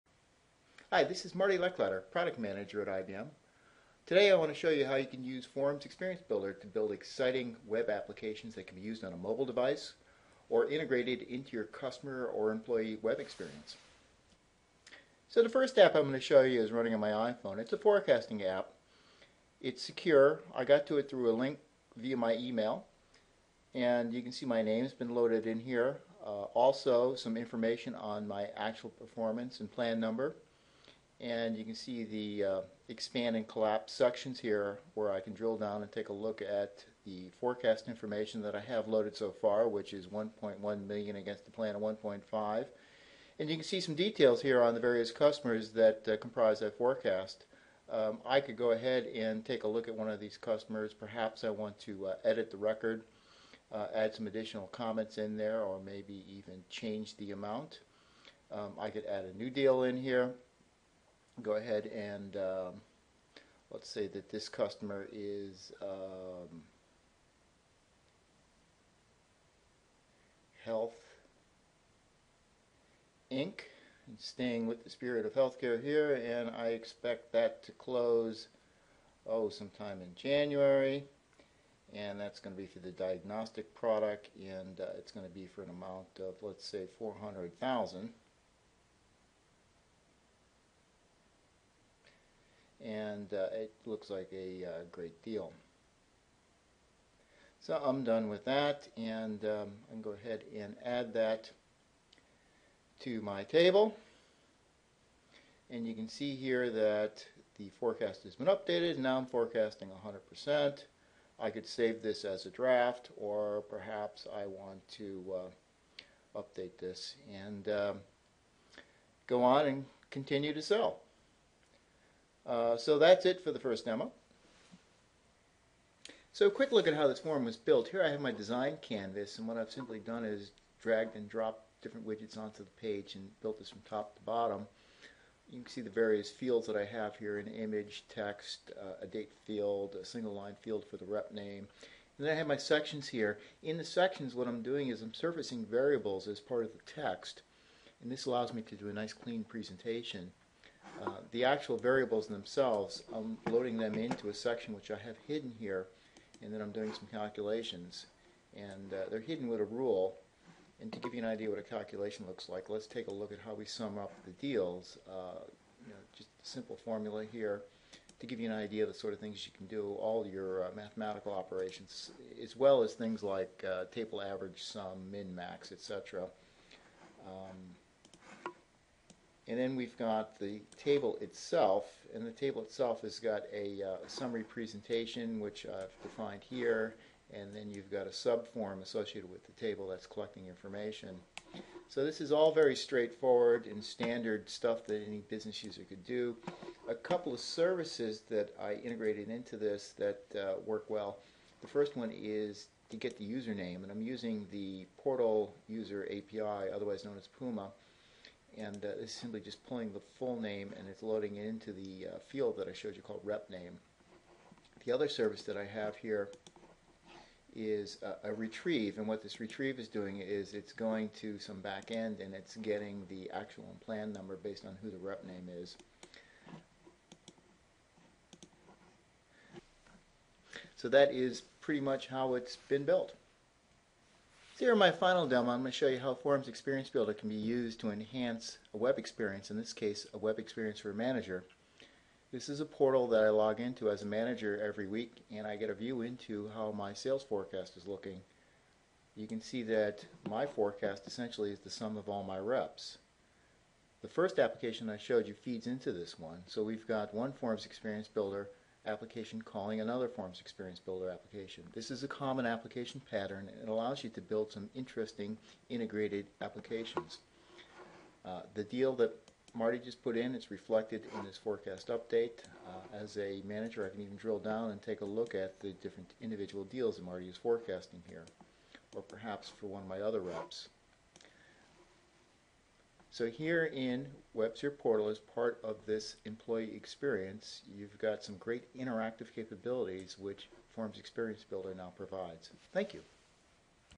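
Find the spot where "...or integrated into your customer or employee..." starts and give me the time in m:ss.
0:10.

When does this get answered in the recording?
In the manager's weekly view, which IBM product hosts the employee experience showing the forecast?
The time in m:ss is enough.
4:44.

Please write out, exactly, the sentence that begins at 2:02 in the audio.
Uh, so that's it for the first demo.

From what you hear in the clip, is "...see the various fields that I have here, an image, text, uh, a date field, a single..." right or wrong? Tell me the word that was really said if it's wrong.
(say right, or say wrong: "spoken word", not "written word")
right.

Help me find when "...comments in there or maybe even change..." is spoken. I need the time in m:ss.
0:54.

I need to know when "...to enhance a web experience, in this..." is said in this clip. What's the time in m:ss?
3:57.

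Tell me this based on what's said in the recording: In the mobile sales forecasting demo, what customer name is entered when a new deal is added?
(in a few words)
Health Inc.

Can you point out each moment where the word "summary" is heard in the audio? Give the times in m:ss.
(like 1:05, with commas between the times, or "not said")
3:04.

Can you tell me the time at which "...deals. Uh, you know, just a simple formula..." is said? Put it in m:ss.
2:44.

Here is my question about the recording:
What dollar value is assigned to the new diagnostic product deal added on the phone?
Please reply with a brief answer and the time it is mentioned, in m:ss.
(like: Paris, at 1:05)
400,000, at 1:26.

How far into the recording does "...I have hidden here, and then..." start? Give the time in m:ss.
2:34.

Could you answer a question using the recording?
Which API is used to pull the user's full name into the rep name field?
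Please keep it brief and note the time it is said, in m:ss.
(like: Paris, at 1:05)
Portal User API, at 3:24.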